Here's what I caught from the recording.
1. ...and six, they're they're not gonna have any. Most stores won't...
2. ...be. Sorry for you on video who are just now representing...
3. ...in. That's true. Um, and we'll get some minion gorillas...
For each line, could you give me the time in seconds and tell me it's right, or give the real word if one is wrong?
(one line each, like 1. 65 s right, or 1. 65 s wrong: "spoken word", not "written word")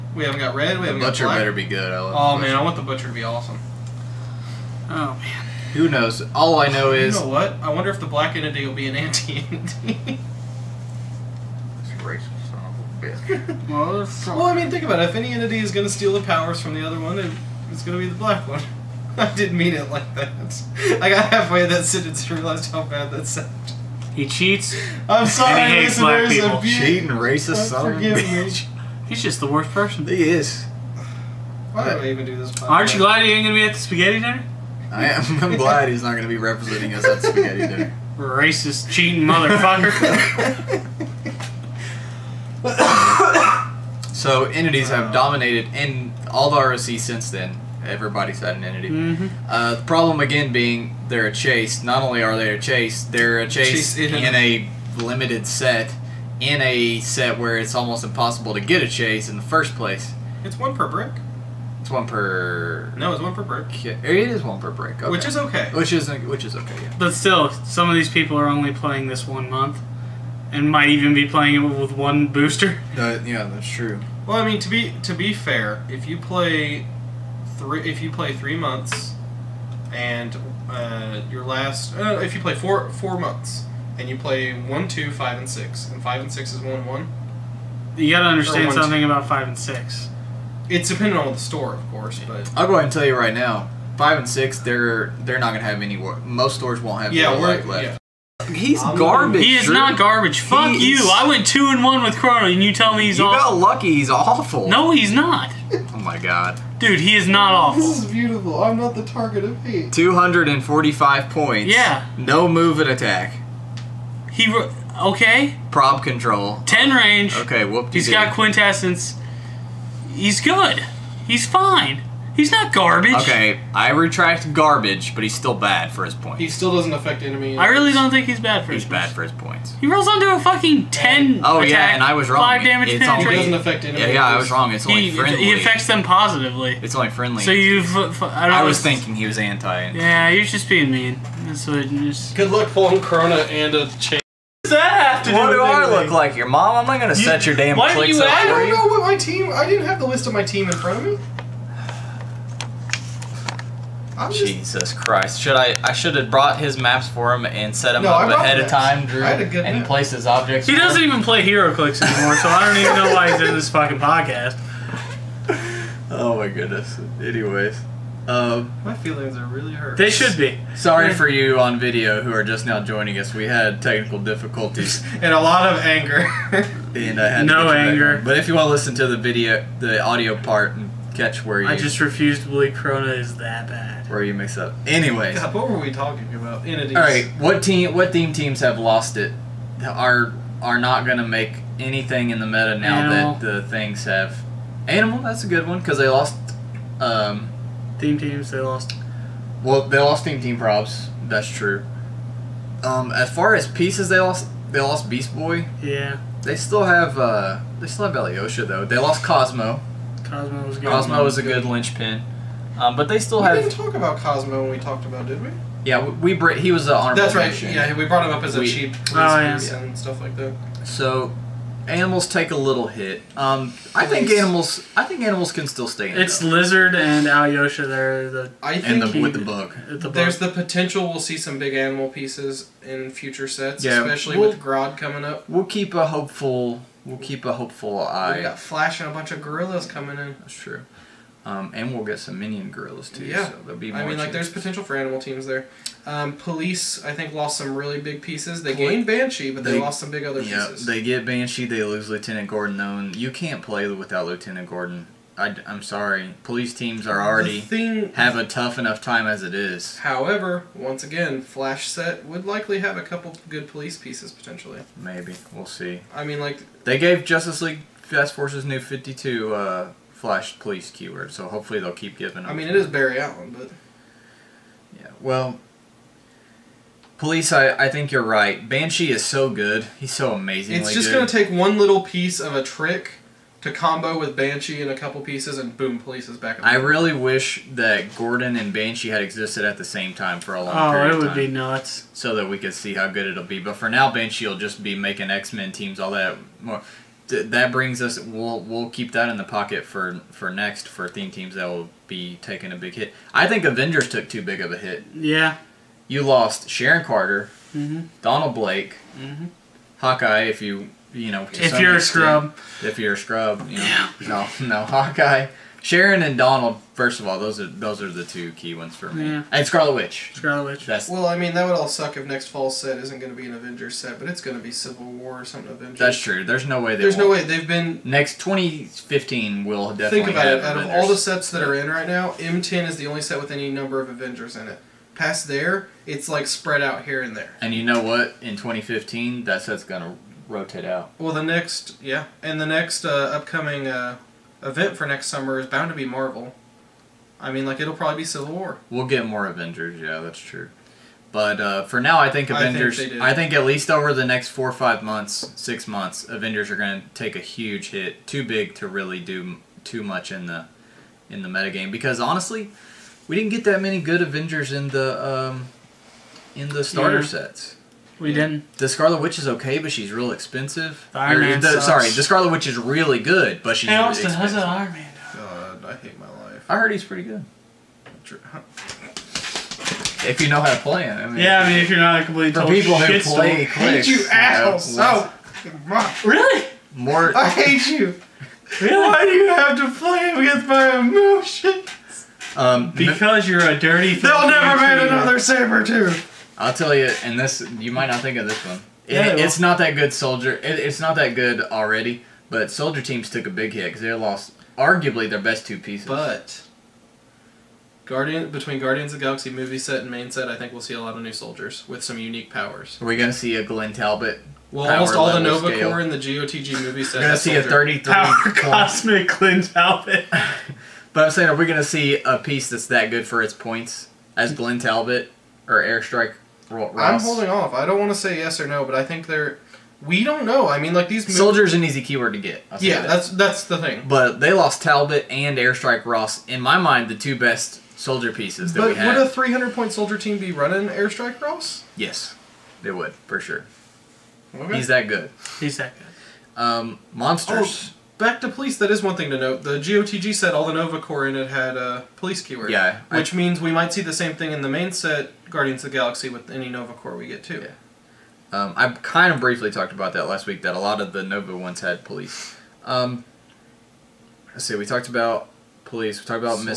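1. 94 s right
2. 170 s wrong: "joining", not "representing"
3. 240 s right.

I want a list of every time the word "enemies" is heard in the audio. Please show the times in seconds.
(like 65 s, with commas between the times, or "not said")
127 s, 133 s.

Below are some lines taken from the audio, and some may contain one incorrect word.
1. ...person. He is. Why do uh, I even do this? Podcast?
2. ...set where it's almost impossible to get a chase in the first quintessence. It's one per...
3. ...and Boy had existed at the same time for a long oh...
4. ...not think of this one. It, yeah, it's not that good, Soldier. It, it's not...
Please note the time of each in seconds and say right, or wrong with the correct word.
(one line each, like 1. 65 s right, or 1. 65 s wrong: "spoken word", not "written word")
1. 29 s right
2. 57 s wrong: "place", not "quintessence"
3. 288 s wrong: "Banshee", not "Boy"
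4. 398 s right.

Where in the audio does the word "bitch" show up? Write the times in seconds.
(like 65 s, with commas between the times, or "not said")
13 s, 28 s.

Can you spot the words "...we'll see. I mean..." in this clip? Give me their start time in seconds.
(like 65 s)
265 s.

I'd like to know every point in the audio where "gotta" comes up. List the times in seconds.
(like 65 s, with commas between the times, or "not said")
88 s.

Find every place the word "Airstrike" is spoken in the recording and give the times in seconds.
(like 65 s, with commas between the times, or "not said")
425 s, 435 s, 440 s.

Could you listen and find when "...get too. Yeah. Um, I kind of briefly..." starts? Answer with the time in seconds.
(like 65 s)
457 s.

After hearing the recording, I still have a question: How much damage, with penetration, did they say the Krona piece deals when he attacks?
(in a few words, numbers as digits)
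5.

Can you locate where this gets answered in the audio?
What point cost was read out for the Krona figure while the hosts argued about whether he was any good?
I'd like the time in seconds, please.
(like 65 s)
109 s.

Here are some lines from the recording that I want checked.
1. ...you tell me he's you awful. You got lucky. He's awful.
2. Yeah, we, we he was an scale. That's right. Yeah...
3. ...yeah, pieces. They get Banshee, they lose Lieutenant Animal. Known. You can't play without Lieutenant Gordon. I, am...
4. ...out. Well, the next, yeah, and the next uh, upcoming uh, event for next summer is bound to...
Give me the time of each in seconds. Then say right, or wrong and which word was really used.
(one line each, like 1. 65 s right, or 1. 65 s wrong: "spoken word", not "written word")
1. 102 s right
2. 215 s wrong: "honorable", not "scale"
3. 250 s wrong: "Gordon", not "Animal"
4. 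340 s right.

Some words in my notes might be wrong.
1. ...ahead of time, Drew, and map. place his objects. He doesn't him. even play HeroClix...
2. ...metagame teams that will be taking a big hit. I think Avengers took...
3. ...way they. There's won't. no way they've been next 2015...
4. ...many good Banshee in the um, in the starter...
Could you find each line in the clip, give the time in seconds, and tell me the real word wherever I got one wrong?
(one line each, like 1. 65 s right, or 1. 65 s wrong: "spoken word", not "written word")
1. 158 s right
2. 301 s wrong: "theme", not "metagame"
3. 326 s right
4. 363 s wrong: "Avengers", not "Banshee".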